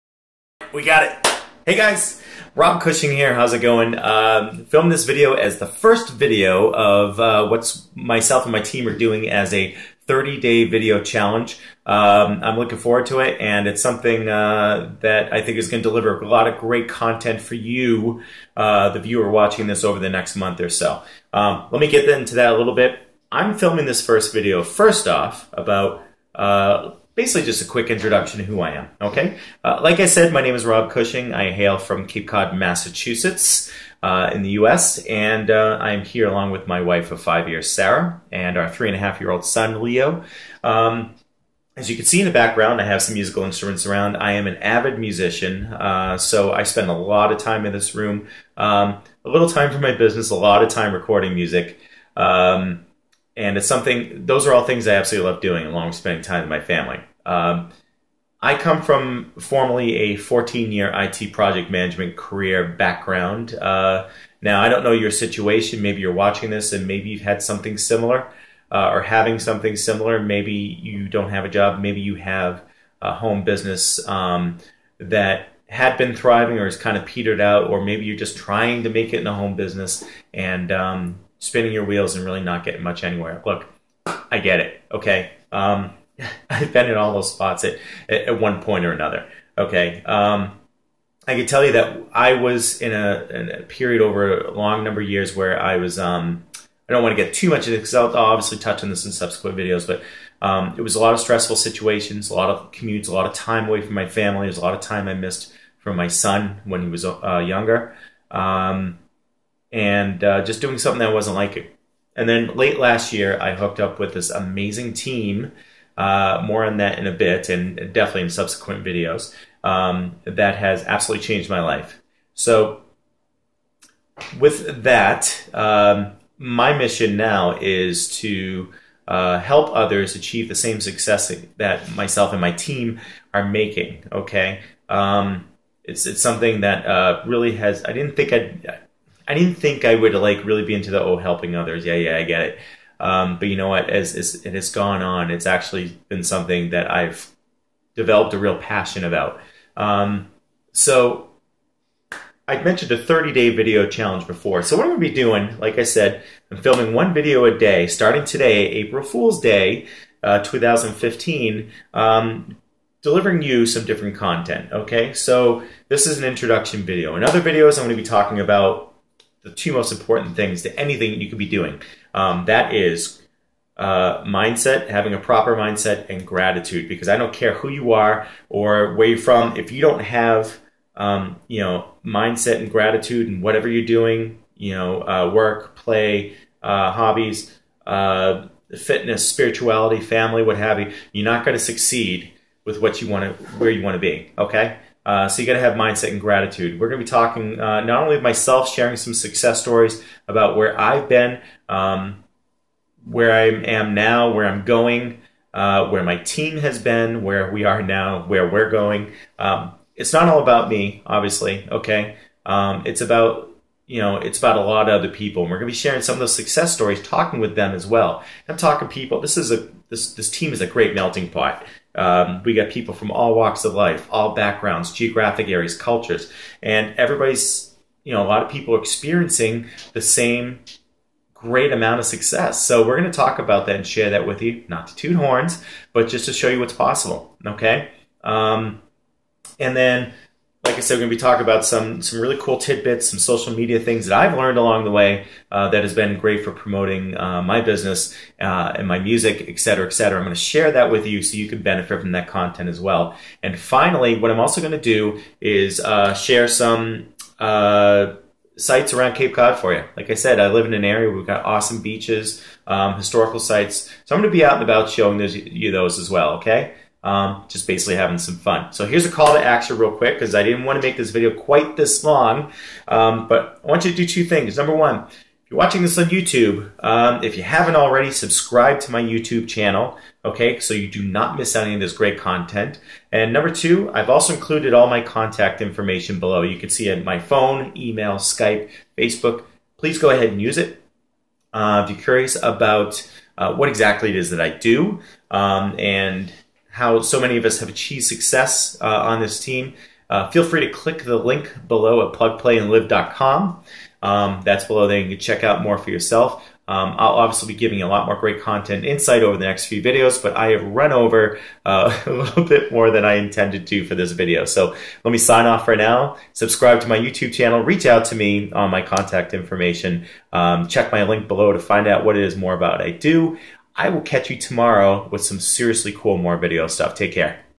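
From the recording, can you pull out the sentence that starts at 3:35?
And we're going to be sharing some of those success stories, talking with them as well.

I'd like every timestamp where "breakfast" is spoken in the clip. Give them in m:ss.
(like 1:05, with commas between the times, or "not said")
not said.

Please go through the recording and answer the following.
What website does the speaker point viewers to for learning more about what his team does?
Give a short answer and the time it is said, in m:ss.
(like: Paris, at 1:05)
plugplayandlive.com, at 5:02.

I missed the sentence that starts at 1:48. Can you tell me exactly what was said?
Um, and uh, just doing something that I wasn't liking.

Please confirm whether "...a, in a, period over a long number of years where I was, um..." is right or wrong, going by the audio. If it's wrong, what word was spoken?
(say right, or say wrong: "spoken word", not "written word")
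right.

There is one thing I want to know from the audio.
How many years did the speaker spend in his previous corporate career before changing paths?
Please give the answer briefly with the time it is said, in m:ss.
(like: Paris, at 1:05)
14, at 1:00.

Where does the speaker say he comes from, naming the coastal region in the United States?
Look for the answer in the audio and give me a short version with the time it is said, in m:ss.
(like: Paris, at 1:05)
Cape Cod, Massachusetts, at 0:32.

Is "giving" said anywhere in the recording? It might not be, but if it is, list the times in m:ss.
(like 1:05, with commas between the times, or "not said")
5:07.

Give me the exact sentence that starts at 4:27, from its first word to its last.
um, just basically having some fun.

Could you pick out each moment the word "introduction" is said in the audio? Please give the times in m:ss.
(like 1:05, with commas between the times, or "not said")
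0:27, 2:46.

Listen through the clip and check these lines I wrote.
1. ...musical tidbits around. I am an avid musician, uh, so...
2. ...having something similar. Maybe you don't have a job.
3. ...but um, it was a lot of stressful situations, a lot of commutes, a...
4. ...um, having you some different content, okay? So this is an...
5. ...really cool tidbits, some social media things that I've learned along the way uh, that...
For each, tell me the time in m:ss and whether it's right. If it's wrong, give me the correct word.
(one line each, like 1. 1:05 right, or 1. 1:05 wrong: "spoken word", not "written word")
1. 0:43 wrong: "instruments", not "tidbits"
2. 1:09 right
3. 1:39 right
4. 2:41 wrong: "delivering", not "having"
5. 4:02 right.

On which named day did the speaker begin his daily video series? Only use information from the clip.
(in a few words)
April Fool's Day.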